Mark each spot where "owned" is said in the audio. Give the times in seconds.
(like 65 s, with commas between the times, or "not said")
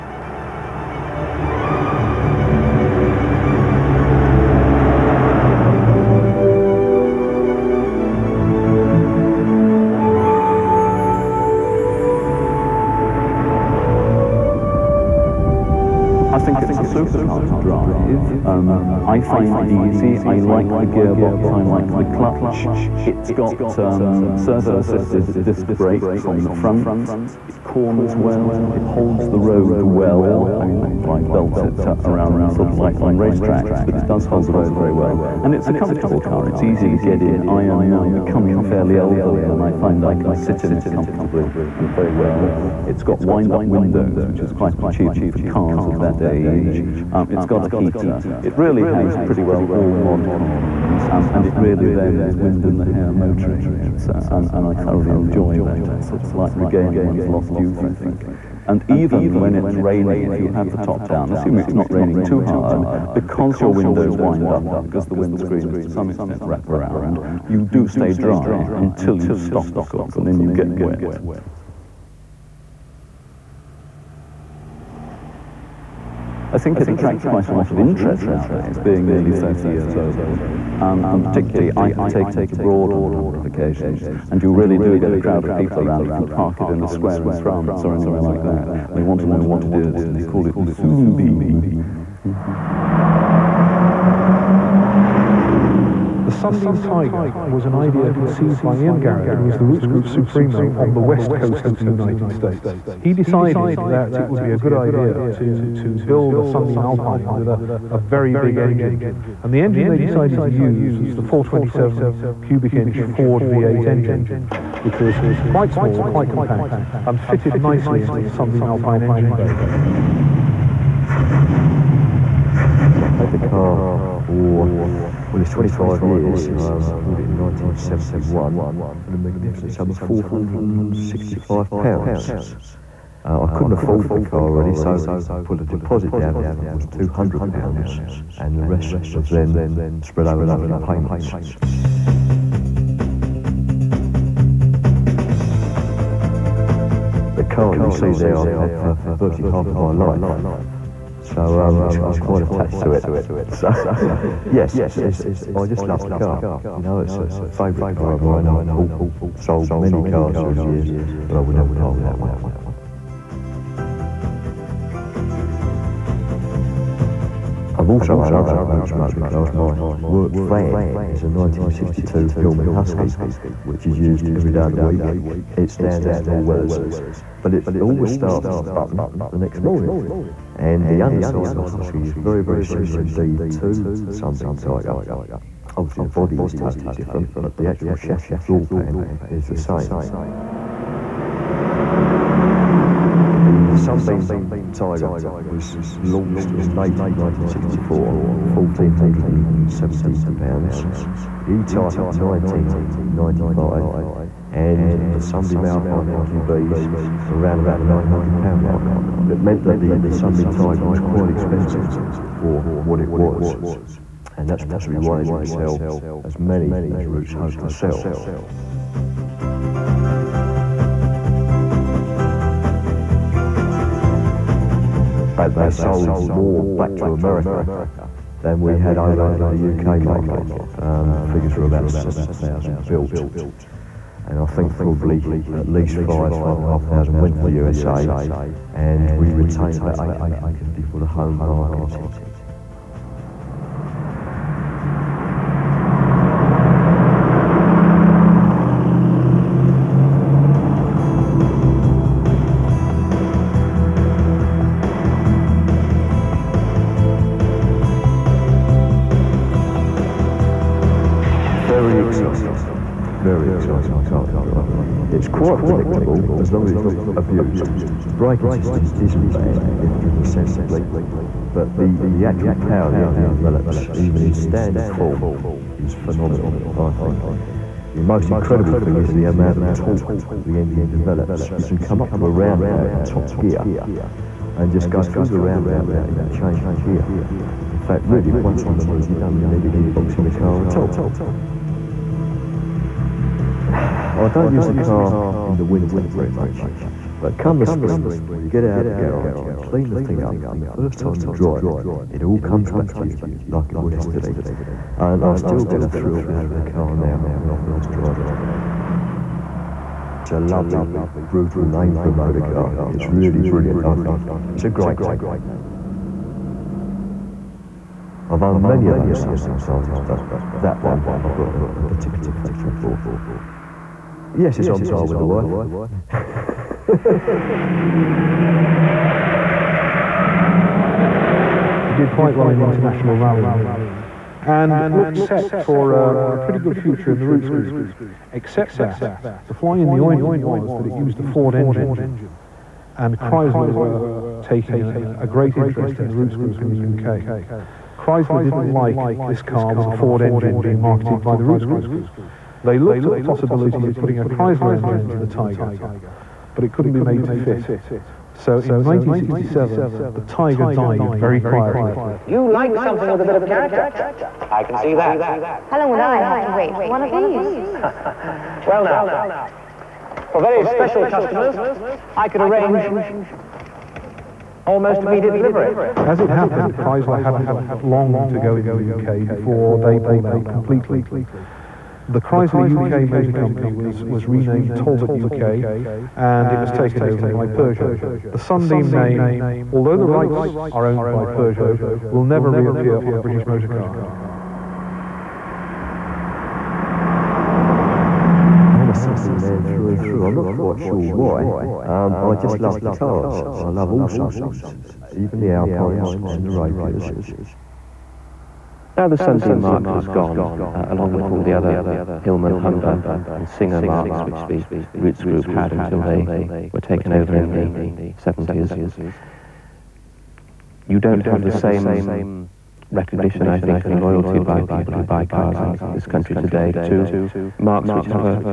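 318 s, 390 s.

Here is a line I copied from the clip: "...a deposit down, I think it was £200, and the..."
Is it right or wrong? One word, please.
right.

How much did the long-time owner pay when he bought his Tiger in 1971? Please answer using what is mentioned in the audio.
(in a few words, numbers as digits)
£465.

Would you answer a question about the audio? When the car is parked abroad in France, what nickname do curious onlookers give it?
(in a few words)
the Soon Beam.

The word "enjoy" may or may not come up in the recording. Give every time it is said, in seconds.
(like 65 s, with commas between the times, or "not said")
55 s.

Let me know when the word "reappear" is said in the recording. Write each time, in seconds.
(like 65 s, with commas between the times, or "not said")
392 s.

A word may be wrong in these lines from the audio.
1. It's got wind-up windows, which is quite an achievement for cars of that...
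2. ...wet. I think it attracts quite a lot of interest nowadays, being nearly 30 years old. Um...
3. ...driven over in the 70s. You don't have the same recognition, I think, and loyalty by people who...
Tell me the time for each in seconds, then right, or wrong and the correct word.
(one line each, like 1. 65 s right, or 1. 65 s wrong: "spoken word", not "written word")
1. 42 s right
2. 70 s right
3. 416 s wrong: "taken", not "driven".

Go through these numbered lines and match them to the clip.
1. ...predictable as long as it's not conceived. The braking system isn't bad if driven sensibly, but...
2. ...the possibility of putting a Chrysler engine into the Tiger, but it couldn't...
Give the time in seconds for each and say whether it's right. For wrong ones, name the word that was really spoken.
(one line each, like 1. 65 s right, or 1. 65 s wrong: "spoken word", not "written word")
1. 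265 s wrong: "abused", not "conceived"
2. 353 s right.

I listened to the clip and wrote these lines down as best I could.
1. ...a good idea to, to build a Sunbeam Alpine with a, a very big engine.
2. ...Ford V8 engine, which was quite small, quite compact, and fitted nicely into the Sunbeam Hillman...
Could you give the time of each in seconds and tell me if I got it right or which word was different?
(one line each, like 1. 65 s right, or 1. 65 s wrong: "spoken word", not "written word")
1. 104 s right
2. 112 s wrong: "Alpine", not "Hillman".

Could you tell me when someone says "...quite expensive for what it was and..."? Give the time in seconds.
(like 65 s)
210 s.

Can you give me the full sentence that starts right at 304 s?
And I still get a thrill out of the car now when I first drive it.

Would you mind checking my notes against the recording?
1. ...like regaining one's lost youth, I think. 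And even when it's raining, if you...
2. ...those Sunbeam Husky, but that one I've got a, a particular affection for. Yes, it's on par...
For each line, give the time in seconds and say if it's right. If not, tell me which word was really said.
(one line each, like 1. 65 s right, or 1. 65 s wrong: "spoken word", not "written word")
1. 56 s right
2. 318 s wrong: "Tigers", not "Husky".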